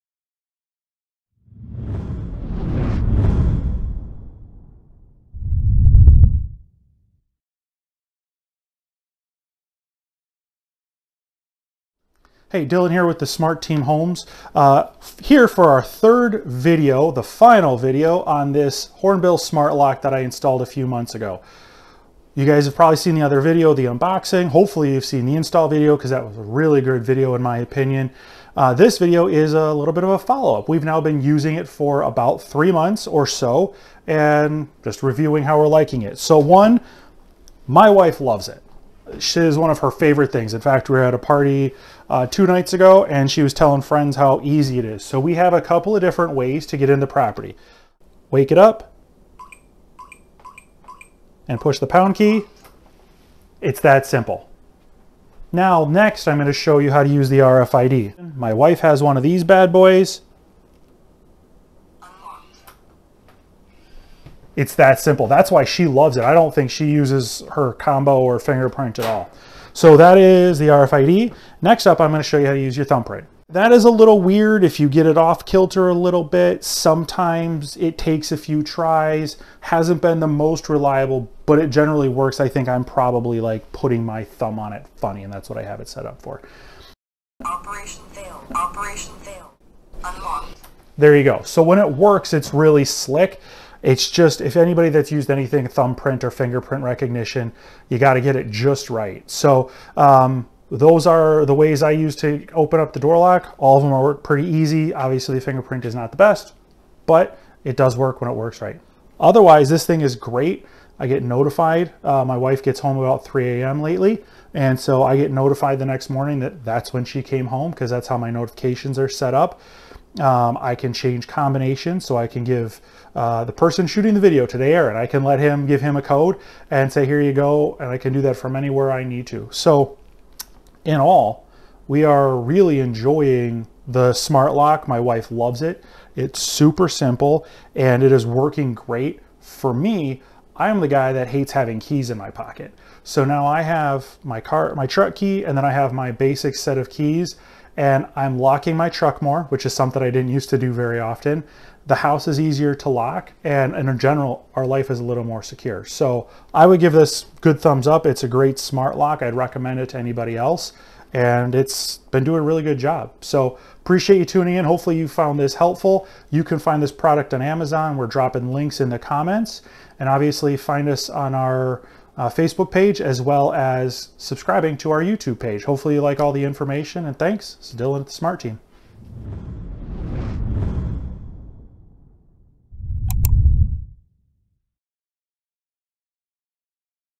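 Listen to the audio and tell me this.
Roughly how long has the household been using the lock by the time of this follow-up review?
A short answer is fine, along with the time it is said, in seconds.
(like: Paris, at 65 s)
3 months, at 32 s.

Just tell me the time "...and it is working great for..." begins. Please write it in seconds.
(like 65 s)
137 s.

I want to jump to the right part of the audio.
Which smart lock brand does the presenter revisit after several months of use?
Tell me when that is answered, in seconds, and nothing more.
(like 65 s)
18 s.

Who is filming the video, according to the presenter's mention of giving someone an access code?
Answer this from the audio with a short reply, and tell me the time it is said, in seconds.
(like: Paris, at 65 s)
Aaron, at 124 s.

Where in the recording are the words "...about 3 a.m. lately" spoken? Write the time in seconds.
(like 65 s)
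112 s.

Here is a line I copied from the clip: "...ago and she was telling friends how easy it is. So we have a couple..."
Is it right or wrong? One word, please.
right.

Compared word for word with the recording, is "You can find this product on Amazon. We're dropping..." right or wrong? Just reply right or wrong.
right.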